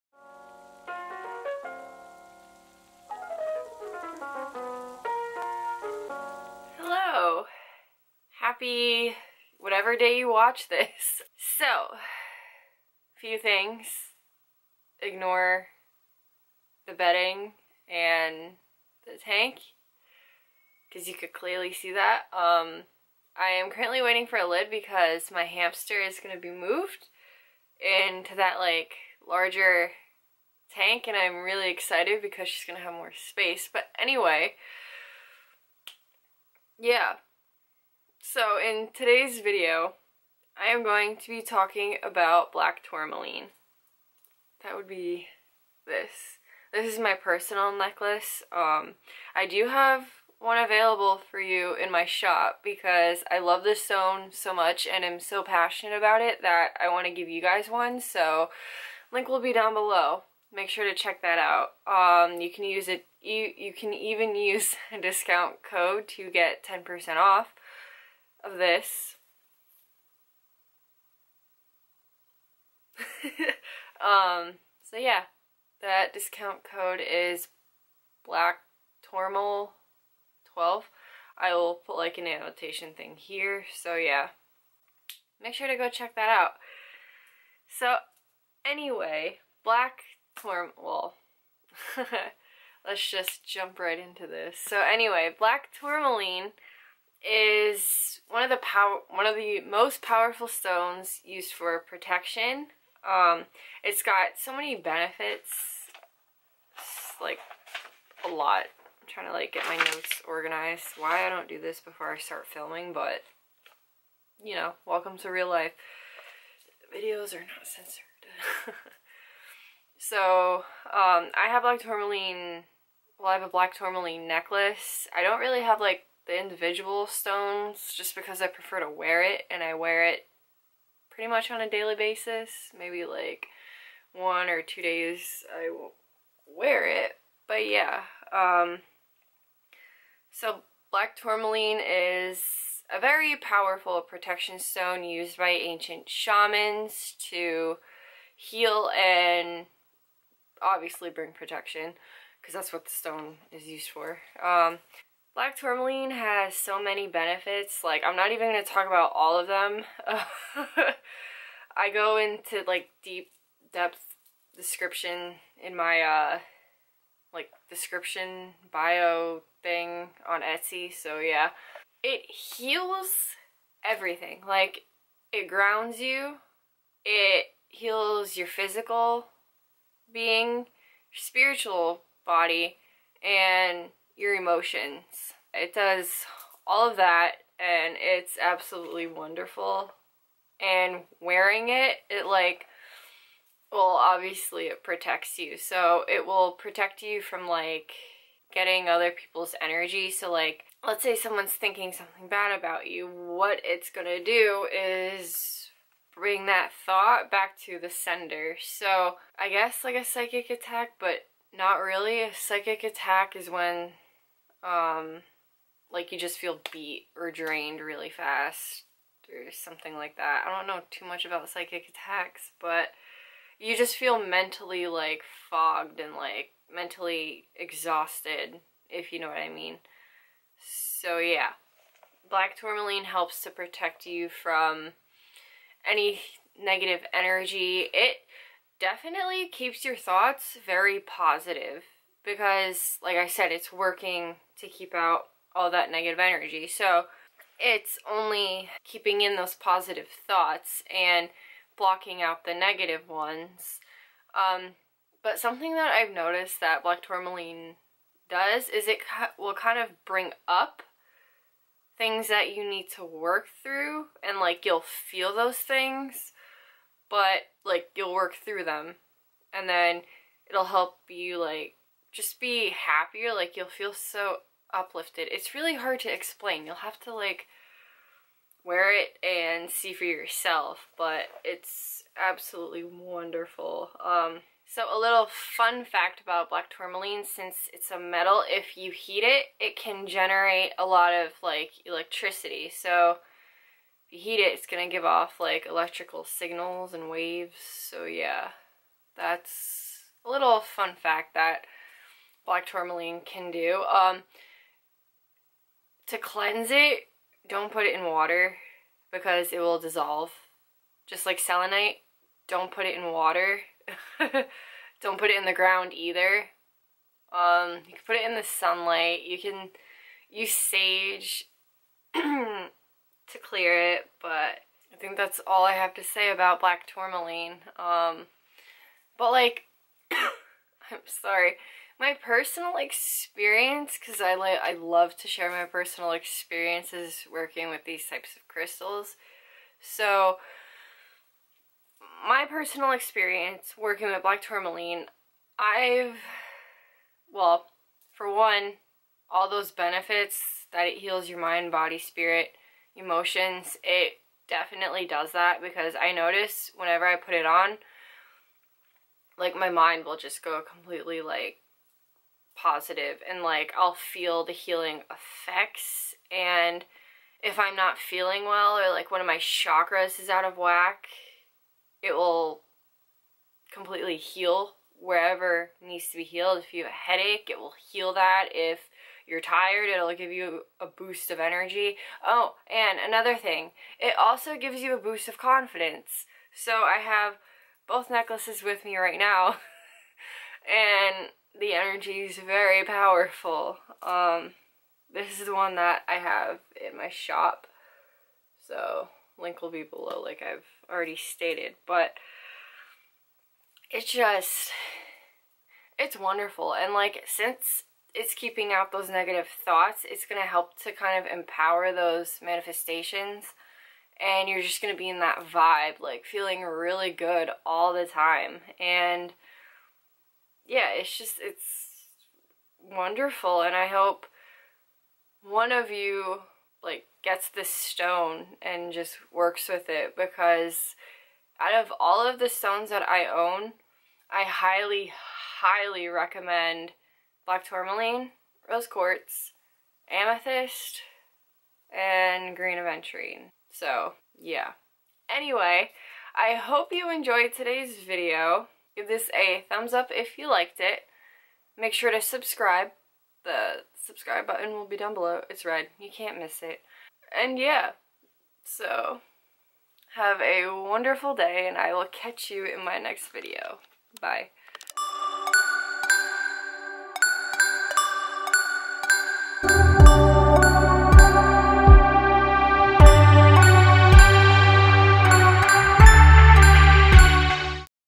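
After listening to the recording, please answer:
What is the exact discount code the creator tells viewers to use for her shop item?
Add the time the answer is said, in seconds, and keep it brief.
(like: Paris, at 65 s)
Black Tourmaline 12, at 78 s.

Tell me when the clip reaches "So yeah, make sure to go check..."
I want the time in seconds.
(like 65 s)
83 s.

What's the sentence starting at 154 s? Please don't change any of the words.
Um, Black tourmaline has so many benefits.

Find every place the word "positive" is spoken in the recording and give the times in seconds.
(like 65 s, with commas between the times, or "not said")
240 s, 249 s, 362 s.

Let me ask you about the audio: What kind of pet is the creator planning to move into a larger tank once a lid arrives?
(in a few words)
Hamster.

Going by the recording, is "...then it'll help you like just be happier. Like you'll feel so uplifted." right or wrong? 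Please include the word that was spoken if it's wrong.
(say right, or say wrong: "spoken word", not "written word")
right.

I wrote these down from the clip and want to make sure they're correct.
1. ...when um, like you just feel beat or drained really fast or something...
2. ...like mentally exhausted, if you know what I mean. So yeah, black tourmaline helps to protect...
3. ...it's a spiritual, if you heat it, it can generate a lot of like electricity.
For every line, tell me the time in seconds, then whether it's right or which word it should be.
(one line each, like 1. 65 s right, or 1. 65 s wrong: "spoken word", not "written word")
1. 213 s right
2. 226 s right
3. 287 s wrong: "metal", not "spiritual".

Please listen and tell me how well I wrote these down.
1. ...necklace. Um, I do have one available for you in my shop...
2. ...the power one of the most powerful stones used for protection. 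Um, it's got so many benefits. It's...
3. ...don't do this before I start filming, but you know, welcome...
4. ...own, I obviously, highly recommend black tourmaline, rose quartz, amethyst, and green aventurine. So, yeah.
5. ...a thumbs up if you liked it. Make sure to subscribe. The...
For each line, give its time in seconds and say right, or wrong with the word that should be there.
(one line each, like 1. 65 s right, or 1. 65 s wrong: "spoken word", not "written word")
1. 47 s right
2. 98 s right
3. 111 s right
4. 433 s wrong: "highly", not "obviously"
5. 449 s right.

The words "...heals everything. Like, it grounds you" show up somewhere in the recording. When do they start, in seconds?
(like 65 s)
172 s.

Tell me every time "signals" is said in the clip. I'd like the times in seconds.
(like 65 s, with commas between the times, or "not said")
296 s.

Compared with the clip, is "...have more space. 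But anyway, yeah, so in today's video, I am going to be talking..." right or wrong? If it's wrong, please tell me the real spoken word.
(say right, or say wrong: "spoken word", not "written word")
right.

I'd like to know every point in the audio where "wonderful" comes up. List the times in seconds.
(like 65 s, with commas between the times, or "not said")
189 s, 282 s, 406 s, 422 s, 460 s.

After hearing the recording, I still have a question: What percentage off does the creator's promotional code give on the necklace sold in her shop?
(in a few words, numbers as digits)
10%.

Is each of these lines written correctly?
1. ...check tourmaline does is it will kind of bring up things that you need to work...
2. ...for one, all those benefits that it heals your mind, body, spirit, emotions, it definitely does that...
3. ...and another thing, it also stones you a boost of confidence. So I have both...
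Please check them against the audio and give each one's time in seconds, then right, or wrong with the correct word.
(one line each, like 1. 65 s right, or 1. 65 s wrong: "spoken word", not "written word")
1. 256 s wrong: "black", not "check"
2. 348 s right
3. 382 s wrong: "gives", not "stones".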